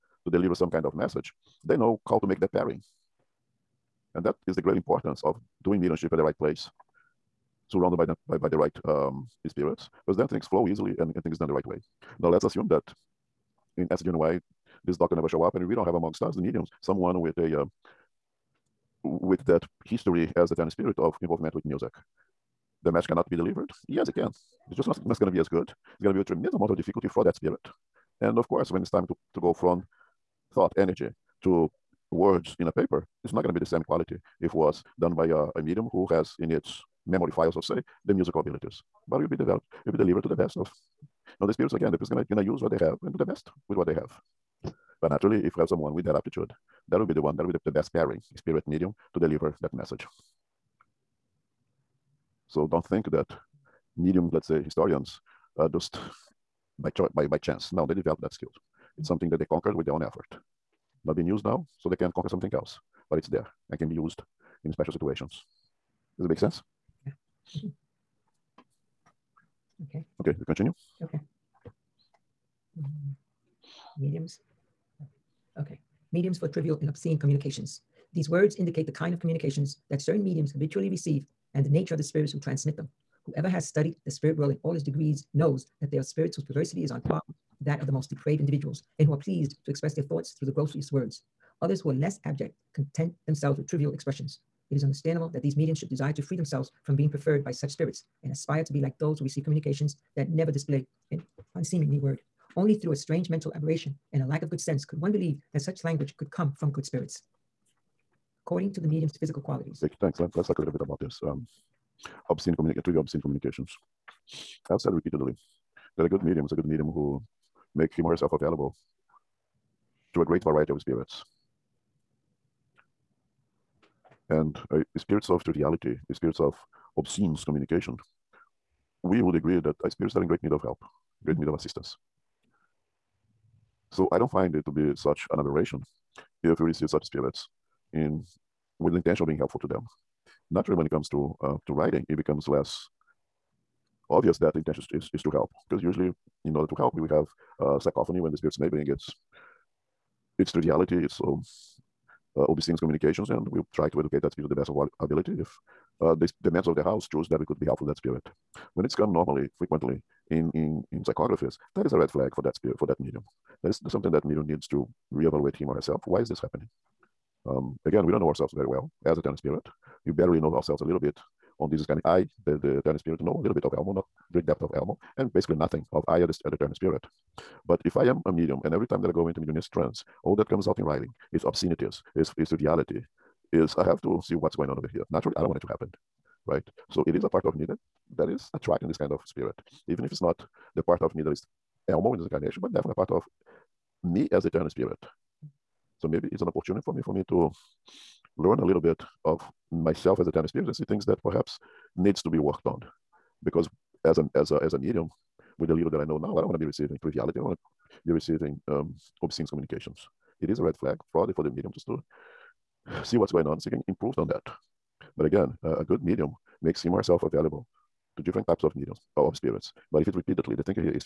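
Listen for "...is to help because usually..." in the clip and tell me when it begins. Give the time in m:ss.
2:25.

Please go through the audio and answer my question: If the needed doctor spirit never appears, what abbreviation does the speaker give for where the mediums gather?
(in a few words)
SGNY.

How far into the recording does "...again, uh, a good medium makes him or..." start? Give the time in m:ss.
3:35.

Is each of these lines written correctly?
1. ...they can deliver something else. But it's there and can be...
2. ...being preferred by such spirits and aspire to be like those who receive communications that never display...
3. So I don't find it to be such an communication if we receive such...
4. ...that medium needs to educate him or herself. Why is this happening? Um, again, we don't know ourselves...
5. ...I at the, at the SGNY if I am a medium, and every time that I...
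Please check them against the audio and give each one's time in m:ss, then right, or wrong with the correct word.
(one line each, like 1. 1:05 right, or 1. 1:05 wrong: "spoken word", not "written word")
1. 1:01 wrong: "conquer", not "deliver"
2. 1:36 right
3. 2:13 wrong: "aberration", not "communication"
4. 2:44 wrong: "reevaluate", not "educate"
5. 2:56 wrong: "But", not "SGNY".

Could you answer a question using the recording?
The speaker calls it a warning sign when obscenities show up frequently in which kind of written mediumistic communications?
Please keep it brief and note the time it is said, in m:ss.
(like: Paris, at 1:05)
psychographies, at 2:41.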